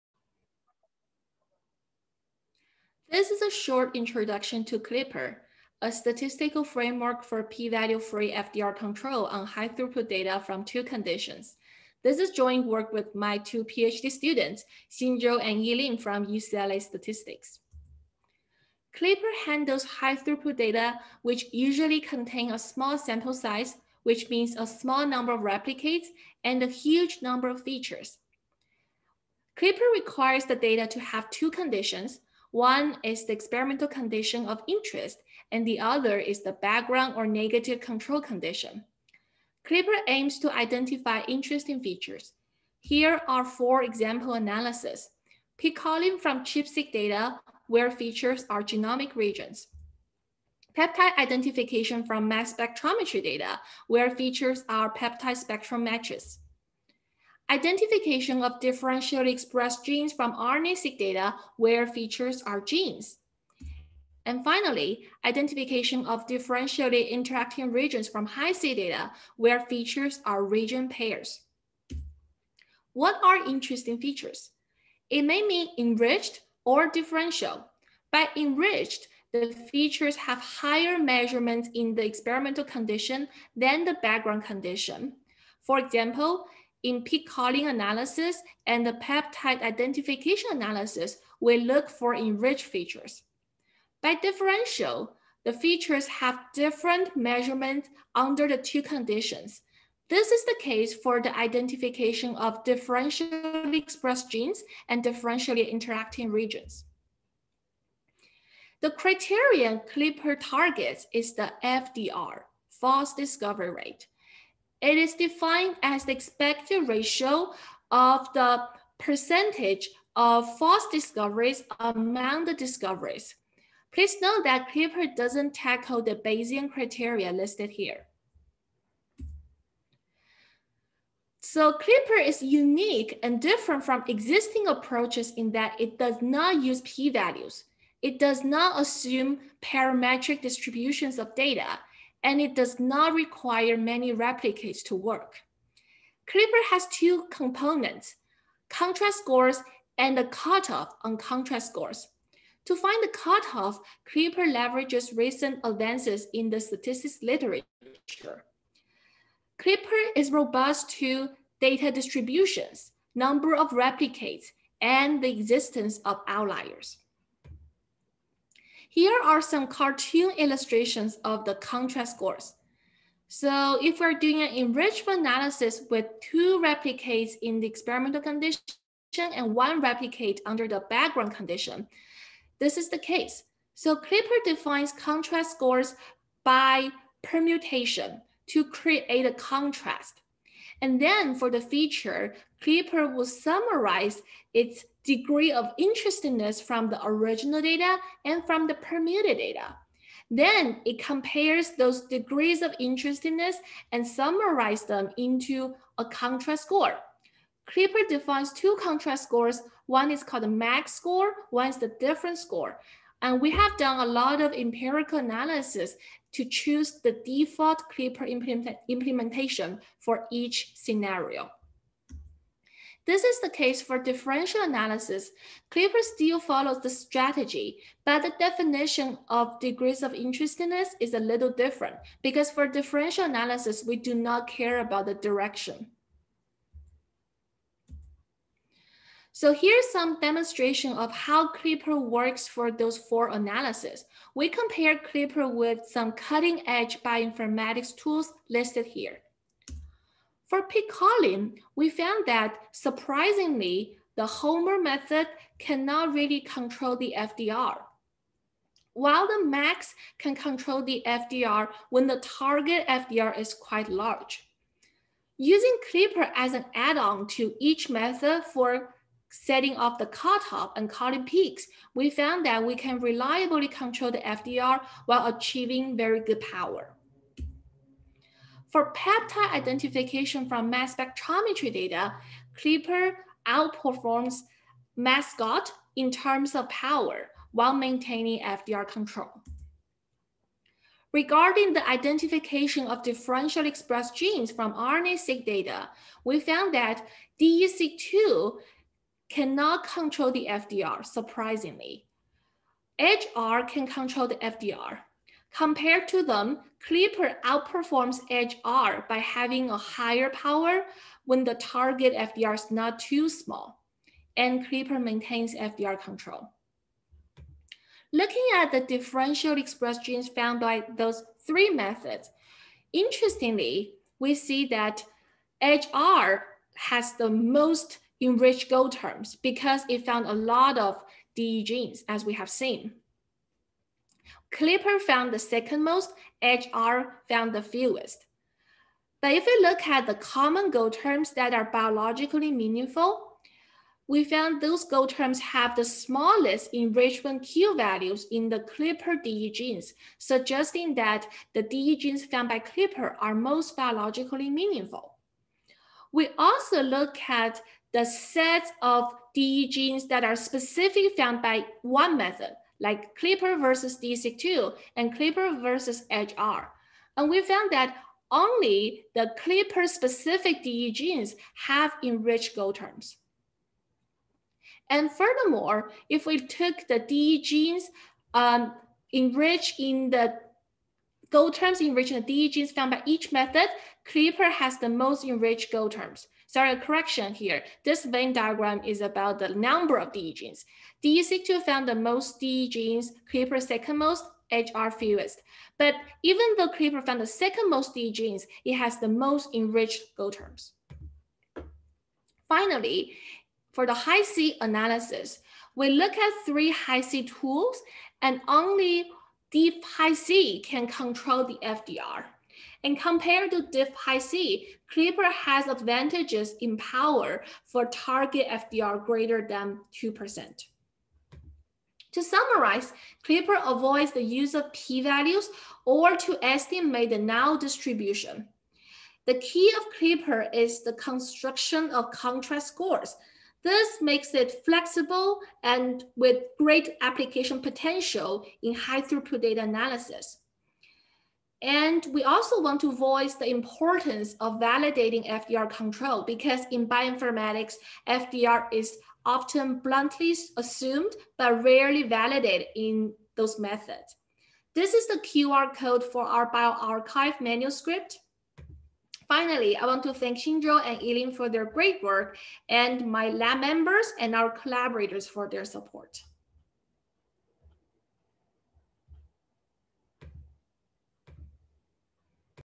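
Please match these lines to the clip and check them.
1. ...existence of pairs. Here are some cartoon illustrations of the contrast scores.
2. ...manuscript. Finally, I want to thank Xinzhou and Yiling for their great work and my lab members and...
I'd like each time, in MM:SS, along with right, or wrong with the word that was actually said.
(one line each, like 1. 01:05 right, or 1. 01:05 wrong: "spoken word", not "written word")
1. 02:45 wrong: "outliers", not "pairs"
2. 07:37 right.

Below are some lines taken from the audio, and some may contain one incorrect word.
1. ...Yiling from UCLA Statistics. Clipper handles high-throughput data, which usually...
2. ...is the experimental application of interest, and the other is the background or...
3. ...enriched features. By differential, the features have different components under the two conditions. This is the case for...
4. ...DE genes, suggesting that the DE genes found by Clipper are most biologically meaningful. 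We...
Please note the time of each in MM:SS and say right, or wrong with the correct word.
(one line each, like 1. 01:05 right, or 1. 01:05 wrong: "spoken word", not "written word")
1. 00:15 right
2. 00:33 wrong: "condition", not "application"
3. 01:32 wrong: "measurements", not "components"
4. 05:49 right.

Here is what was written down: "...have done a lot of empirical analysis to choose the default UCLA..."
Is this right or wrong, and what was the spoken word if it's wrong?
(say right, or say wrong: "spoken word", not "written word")
wrong: "Clipper", not "UCLA".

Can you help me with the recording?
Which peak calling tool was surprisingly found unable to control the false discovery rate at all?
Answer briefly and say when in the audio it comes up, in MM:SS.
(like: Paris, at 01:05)
Homer, at 04:14.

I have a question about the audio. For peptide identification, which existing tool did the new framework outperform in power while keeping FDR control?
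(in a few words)
Mascot.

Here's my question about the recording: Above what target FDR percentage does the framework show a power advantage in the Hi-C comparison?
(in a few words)
2%.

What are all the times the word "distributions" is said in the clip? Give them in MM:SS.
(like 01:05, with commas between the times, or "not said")
02:20, 02:41, 07:07.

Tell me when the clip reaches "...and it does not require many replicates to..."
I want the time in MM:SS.
02:22.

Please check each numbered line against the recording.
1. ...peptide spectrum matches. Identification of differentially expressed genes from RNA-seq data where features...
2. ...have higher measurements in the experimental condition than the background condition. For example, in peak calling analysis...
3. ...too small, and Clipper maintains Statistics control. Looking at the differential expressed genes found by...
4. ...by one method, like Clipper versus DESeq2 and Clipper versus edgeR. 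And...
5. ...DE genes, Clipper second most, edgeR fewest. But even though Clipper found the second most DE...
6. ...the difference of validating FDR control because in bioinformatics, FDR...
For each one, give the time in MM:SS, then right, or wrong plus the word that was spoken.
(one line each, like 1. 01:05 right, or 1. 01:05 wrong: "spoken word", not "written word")
1. 00:54 right
2. 01:20 right
3. 05:12 wrong: "FDR", not "Statistics"
4. 06:01 right
5. 06:32 right
6. 07:23 wrong: "importance", not "difference".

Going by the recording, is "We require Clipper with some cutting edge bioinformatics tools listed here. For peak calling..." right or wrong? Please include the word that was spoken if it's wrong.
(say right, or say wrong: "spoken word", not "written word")
wrong: "compare", not "require".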